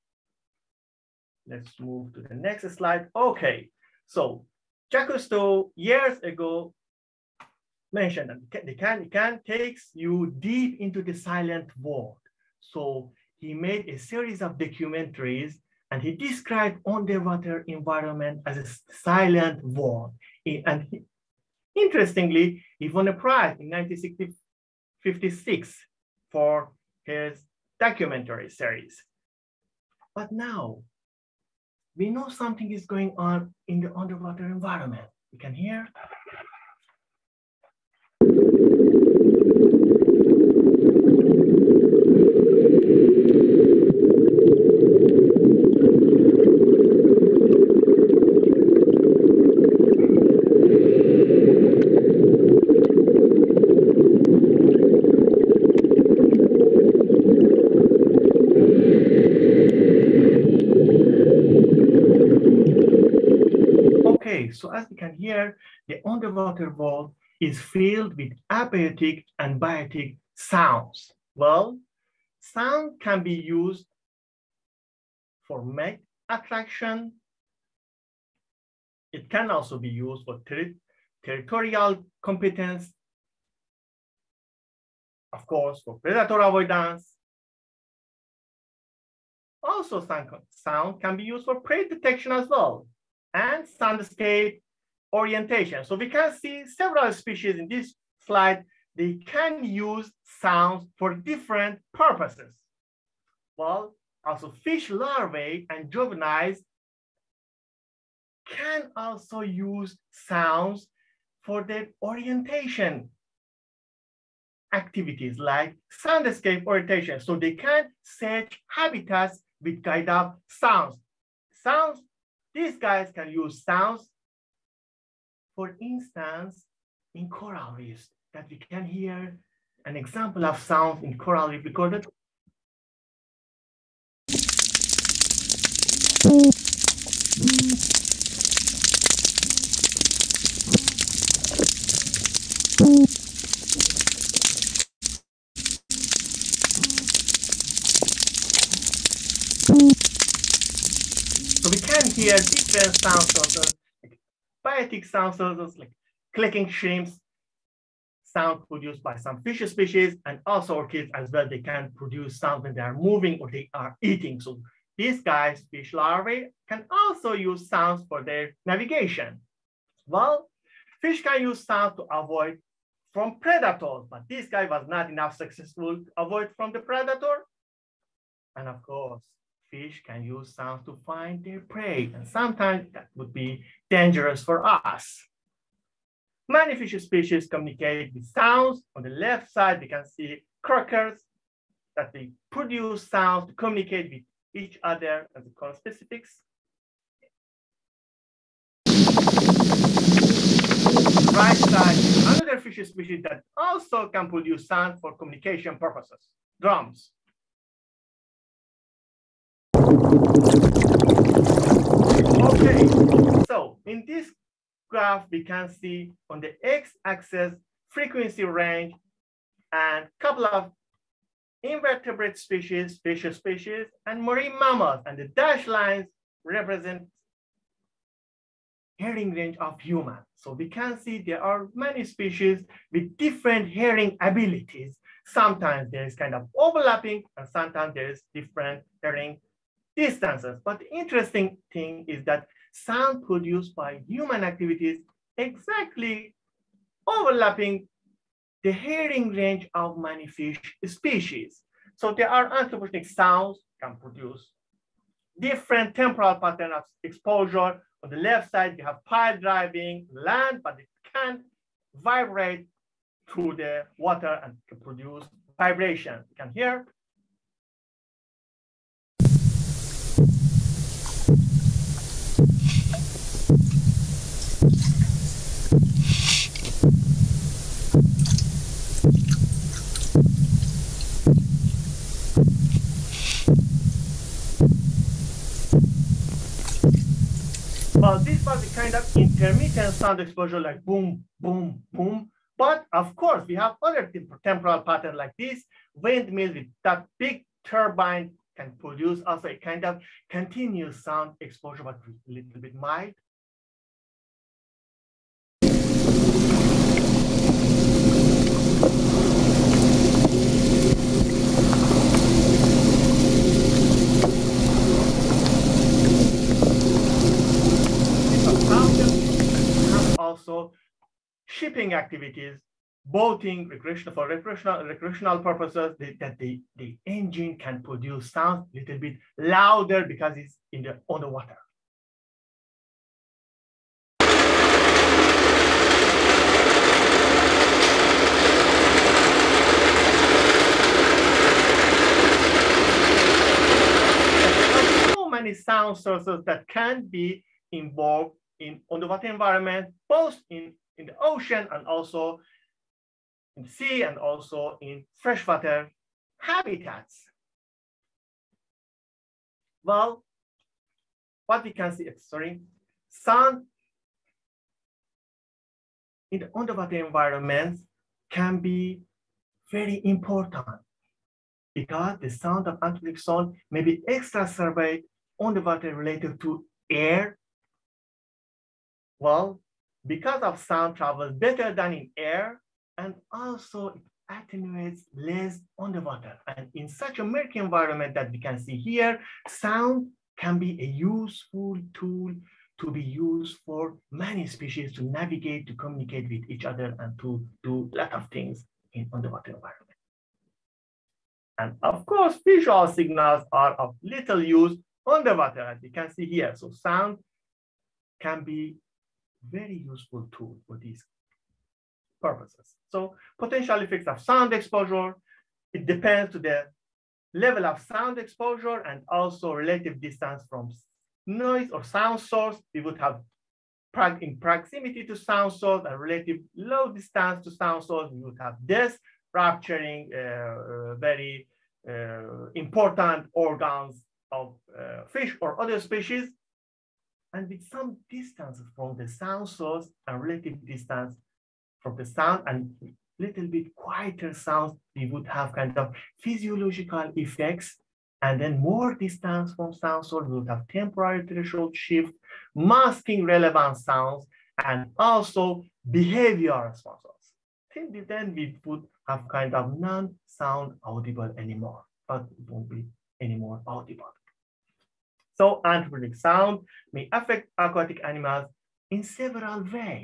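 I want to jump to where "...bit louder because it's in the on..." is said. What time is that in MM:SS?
05:28.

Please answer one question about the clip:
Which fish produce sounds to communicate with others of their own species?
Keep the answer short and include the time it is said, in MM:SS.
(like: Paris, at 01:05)
Croakers, at 03:10.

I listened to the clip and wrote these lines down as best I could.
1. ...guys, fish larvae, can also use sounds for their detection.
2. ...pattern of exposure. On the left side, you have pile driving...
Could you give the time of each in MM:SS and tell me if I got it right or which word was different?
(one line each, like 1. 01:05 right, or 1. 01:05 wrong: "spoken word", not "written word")
1. 02:45 wrong: "navigation", not "detection"
2. 04:16 right.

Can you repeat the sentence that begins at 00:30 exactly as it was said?
But now we know something is going on in the underwater environment.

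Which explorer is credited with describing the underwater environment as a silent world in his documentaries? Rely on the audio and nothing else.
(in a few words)
Jacques Cousteau.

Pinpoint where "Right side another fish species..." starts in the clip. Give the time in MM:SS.
03:21.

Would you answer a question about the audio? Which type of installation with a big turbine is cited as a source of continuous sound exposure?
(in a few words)
Windmill.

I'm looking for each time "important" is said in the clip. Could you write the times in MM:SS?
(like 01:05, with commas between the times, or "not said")
06:10, 07:12.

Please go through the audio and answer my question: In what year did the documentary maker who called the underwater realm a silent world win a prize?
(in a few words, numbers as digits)
1956.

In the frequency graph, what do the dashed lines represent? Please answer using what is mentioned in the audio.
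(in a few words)
Hearing range of human.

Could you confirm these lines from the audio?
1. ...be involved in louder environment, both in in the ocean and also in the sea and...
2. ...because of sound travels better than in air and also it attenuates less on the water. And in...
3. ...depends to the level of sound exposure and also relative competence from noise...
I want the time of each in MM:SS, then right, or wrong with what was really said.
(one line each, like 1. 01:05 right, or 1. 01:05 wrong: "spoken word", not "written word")
1. 05:47 wrong: "underwater", not "louder"
2. 06:20 right
3. 06:55 wrong: "distance", not "competence".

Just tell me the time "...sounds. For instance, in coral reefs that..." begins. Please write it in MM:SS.
02:03.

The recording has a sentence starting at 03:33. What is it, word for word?
So in this graph, we can see on the x-axis frequency range and couple of invertebrate species, fish species, and marine mammals.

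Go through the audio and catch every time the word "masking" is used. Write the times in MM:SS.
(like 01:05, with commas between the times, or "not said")
07:32.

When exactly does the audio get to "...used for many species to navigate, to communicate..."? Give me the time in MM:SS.
06:33.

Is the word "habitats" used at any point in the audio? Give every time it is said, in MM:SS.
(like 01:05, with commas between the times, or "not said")
01:58, 05:56.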